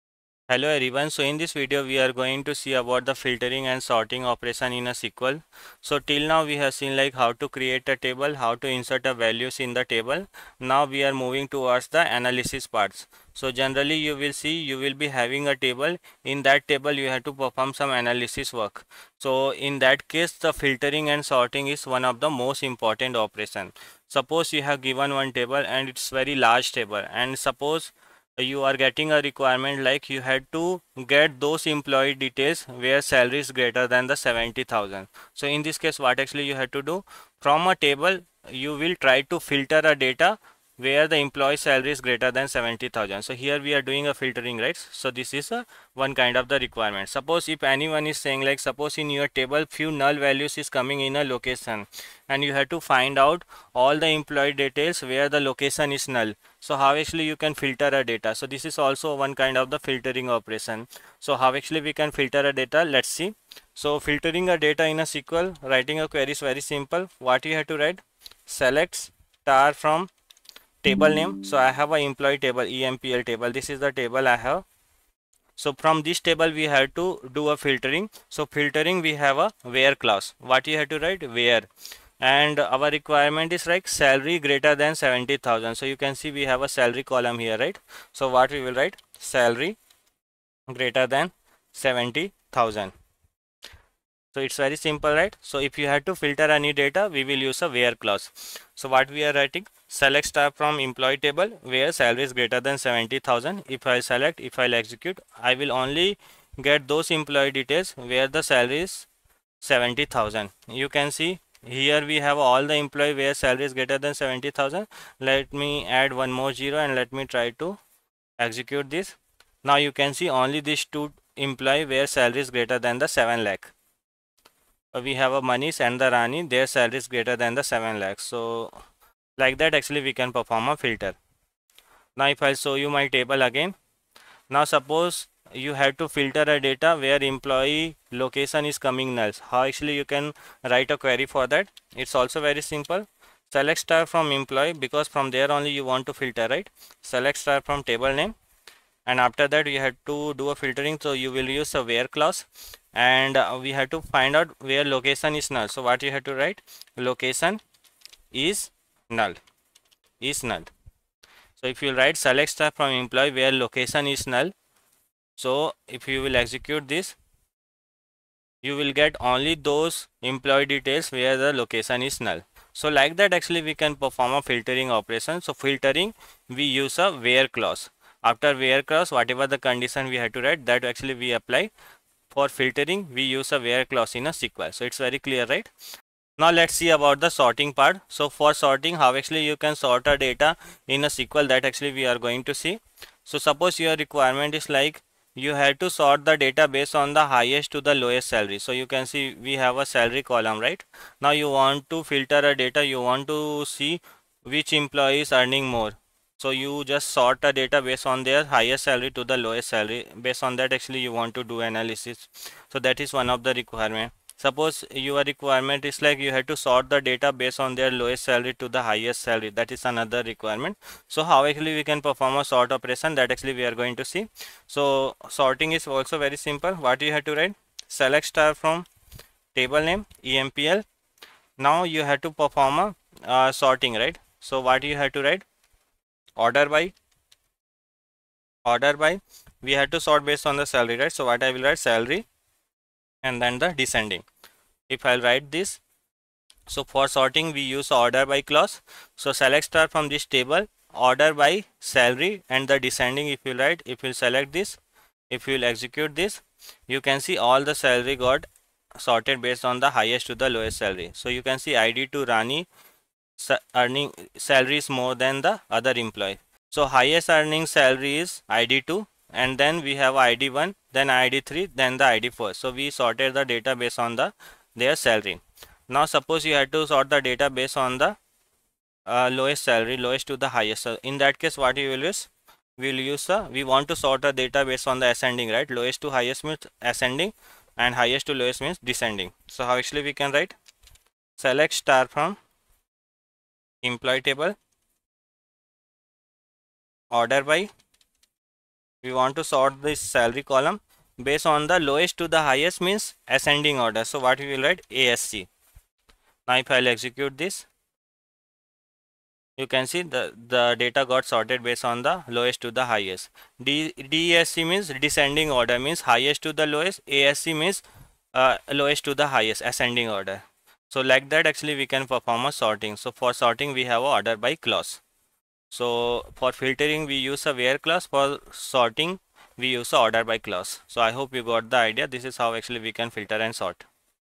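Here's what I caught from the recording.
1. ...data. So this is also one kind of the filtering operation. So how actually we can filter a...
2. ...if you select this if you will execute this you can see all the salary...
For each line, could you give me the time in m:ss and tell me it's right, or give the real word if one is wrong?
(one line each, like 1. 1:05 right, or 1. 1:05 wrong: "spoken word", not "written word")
1. 0:58 right
2. 4:13 right.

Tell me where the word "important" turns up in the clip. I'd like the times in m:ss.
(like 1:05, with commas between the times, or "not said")
0:22.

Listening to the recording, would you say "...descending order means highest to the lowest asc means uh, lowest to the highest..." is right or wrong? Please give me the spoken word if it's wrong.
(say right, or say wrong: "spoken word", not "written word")
right.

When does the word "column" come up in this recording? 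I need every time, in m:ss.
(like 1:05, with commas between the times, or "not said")
1:27, 3:20, 5:00.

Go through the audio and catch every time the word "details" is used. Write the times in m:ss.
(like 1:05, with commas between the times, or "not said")
0:32, 0:54, 1:47, 2:50.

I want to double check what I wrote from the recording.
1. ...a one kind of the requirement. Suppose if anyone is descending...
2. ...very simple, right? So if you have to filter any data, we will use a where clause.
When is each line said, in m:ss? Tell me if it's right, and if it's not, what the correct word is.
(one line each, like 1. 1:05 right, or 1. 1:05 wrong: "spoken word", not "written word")
1. 0:45 wrong: "saying", not "descending"
2. 1:34 right.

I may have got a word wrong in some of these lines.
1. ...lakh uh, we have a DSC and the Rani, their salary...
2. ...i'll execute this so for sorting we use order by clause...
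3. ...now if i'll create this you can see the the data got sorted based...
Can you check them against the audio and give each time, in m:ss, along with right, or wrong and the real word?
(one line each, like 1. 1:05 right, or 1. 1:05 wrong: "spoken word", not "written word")
1. 2:03 wrong: "Manish", not "DSC"
2. 4:05 wrong: "write", not "execute"
3. 5:06 wrong: "execute", not "create".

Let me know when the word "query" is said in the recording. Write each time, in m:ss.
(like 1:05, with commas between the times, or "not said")
1:06, 2:20.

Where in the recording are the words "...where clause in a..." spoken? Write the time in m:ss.
3:03.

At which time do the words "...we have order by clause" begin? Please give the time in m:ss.
5:23.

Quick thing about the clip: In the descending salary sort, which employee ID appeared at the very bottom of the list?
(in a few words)
ID4.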